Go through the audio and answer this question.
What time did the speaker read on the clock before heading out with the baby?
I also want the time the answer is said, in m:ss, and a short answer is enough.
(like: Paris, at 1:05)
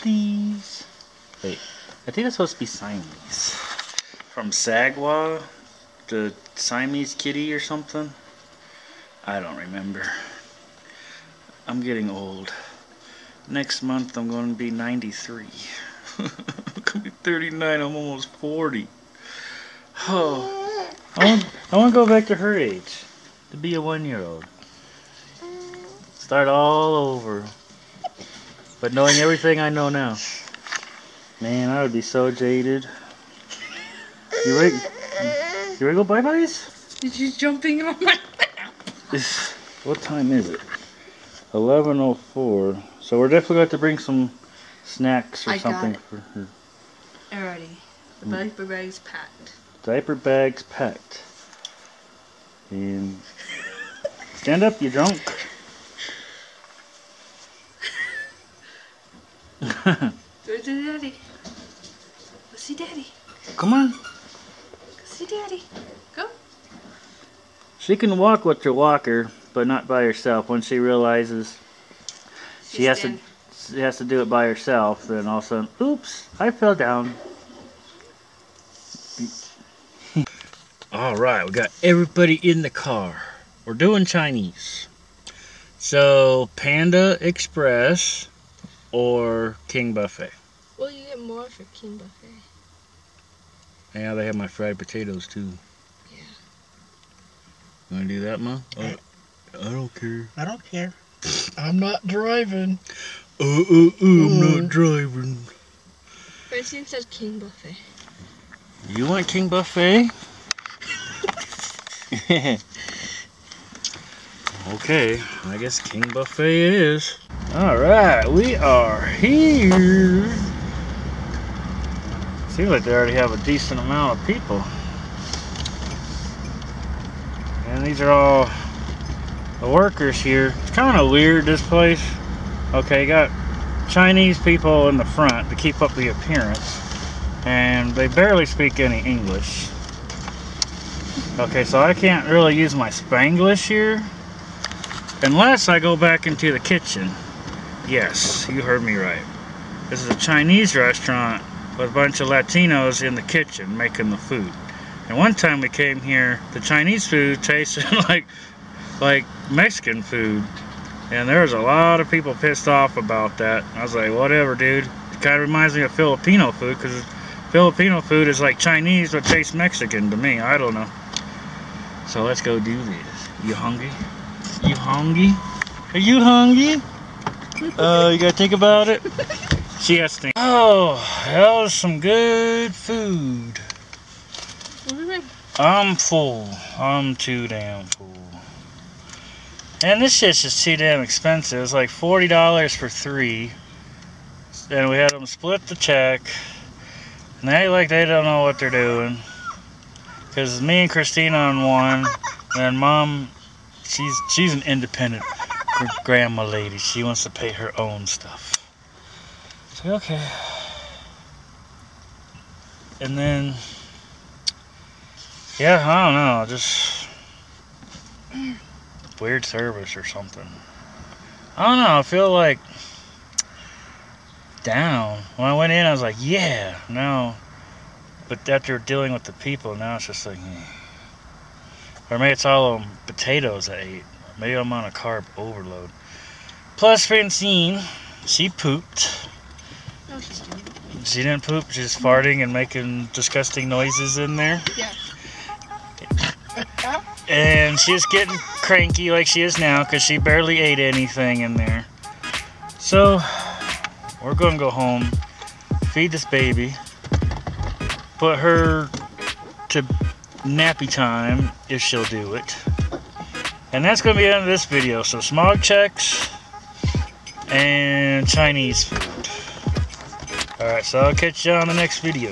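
11:04, at 0:41.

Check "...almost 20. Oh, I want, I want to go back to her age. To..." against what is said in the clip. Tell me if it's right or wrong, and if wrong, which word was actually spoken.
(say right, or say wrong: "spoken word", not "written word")
wrong: "40", not "20".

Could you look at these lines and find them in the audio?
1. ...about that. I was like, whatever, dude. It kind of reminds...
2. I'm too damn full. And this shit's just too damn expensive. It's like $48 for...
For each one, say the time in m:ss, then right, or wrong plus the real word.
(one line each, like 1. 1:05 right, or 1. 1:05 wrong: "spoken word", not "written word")
1. 2:42 right
2. 3:06 wrong: "40", not "48".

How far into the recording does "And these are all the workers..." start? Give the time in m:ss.
2:07.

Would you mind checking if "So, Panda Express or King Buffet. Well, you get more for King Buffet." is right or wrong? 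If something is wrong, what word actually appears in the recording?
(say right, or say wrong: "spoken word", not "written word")
right.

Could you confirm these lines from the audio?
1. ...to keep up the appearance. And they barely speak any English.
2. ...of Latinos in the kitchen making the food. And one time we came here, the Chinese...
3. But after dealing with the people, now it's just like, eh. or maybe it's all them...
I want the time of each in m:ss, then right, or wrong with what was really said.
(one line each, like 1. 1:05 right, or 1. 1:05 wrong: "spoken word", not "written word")
1. 2:15 right
2. 2:32 right
3. 3:48 right.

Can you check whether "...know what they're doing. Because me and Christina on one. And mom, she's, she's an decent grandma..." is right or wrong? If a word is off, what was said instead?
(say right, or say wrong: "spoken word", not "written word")
wrong: "independent", not "decent".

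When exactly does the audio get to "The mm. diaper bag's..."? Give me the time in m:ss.
0:48.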